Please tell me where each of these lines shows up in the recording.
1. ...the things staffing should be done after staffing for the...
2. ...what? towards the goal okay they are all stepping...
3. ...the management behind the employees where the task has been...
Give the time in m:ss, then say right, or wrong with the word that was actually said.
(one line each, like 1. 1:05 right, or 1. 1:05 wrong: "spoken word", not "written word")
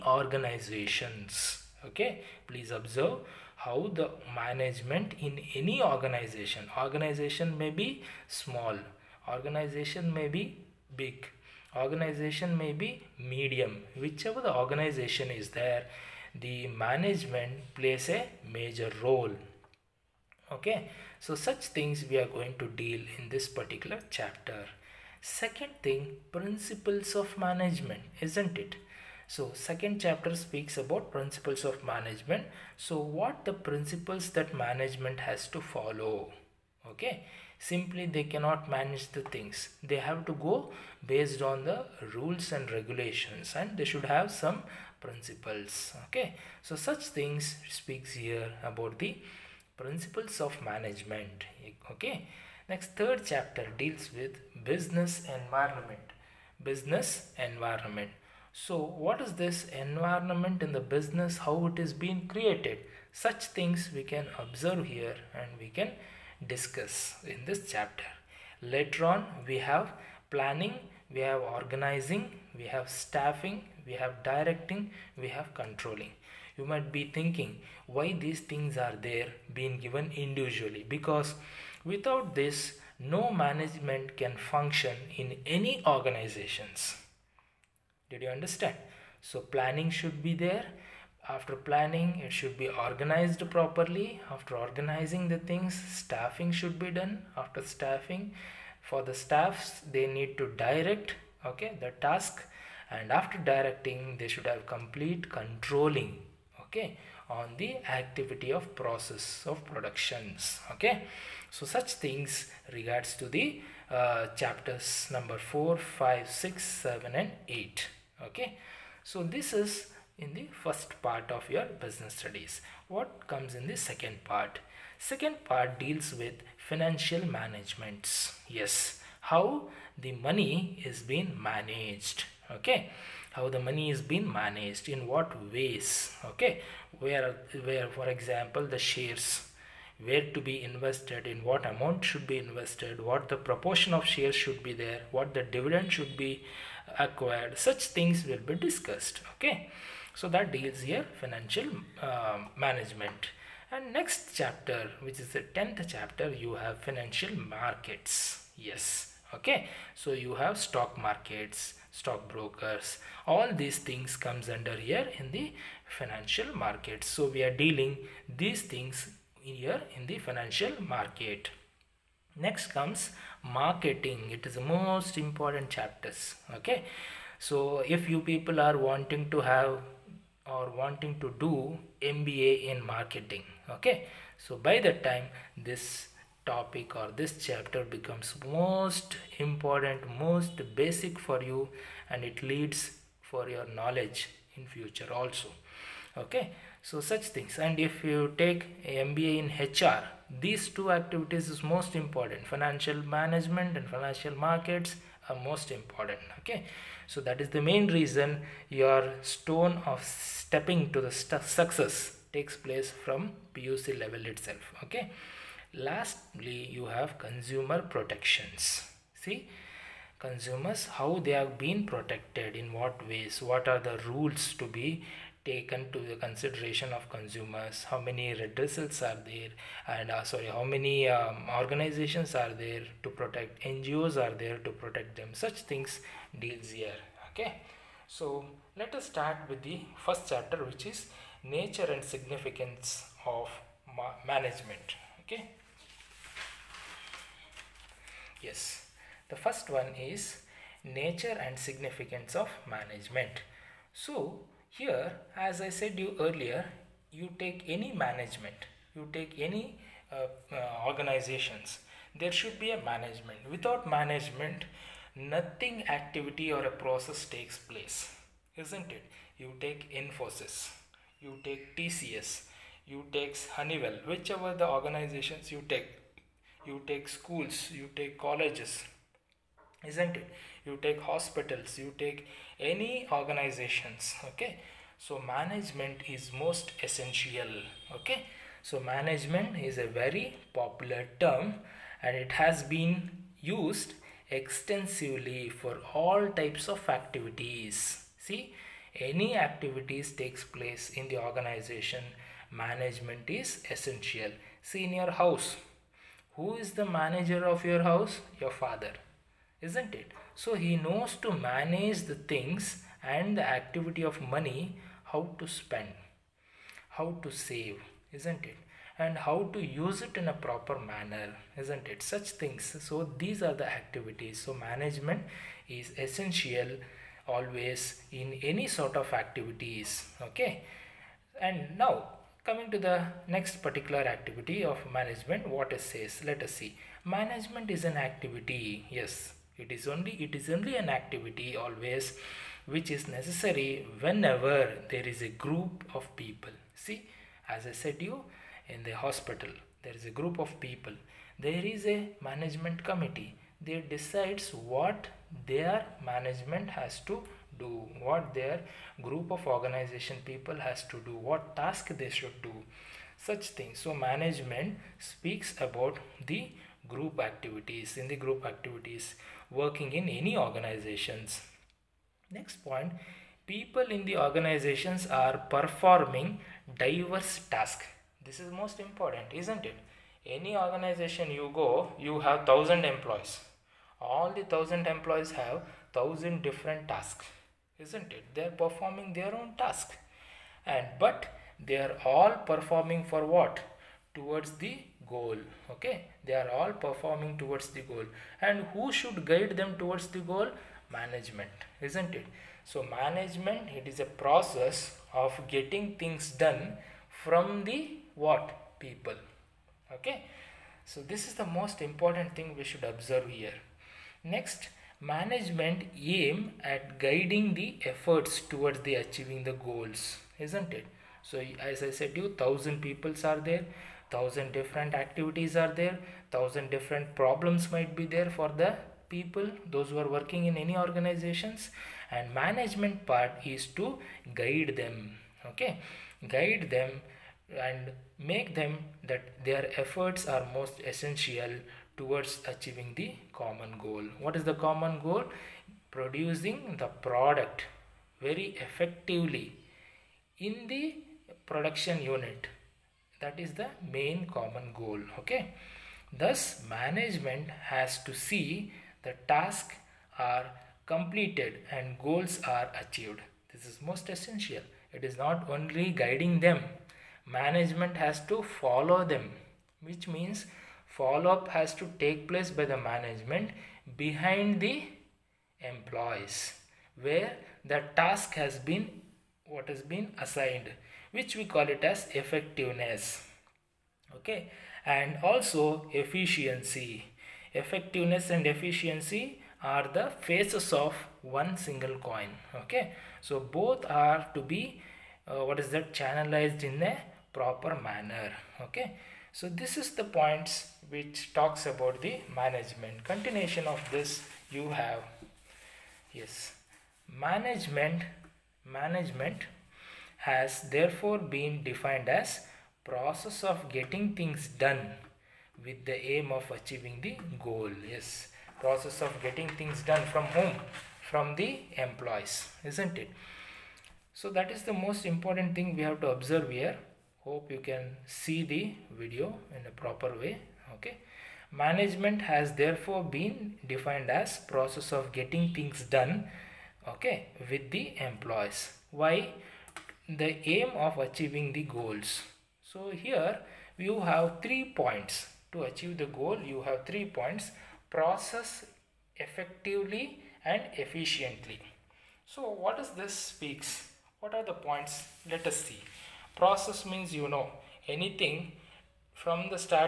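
1. 1:35 right
2. 6:33 wrong: "performing", not "stepping"
3. 7:52 right.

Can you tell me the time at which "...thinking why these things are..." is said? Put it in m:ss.
1:17.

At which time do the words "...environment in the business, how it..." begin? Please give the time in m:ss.
0:59.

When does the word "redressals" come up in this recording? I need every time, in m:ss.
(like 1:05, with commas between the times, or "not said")
3:48.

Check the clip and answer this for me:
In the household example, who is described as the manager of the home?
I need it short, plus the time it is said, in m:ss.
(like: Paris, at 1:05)
Your father, at 5:08.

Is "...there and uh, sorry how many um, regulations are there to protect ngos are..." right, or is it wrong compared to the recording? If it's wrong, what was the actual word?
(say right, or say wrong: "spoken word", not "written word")
wrong: "organizations", not "regulations".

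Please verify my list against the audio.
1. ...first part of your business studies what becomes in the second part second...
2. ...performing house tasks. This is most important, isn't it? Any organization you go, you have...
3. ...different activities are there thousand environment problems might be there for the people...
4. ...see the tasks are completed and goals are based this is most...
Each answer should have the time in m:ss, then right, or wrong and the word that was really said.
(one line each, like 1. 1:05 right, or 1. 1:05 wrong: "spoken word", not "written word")
1. 2:00 wrong: "comes", not "becomes"
2. 6:15 wrong: "diverse", not "house"
3. 7:04 wrong: "different", not "environment"
4. 7:38 wrong: "achieved", not "based".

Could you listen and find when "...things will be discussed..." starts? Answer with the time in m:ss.
2:27.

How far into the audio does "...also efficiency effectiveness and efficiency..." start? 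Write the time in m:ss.
8:05.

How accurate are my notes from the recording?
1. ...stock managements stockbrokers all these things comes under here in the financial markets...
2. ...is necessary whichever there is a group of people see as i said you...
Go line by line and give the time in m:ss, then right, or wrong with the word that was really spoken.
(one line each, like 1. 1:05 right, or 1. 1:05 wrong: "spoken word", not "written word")
1. 2:40 wrong: "markets", not "managements"
2. 5:42 wrong: "whenever", not "whichever".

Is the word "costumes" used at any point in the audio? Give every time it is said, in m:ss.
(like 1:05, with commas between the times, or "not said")
not said.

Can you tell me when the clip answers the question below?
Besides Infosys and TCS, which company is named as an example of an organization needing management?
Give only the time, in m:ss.
4:33.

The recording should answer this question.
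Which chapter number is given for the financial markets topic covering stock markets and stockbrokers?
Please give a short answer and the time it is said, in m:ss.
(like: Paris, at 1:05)
10th, at 2:35.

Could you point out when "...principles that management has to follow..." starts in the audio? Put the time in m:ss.
0:33.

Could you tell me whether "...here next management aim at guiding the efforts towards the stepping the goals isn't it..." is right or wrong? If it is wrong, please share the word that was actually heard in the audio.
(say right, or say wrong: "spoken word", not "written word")
wrong: "achieving", not "stepping".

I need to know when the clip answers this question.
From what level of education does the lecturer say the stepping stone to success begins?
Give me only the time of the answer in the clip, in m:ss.
3:33.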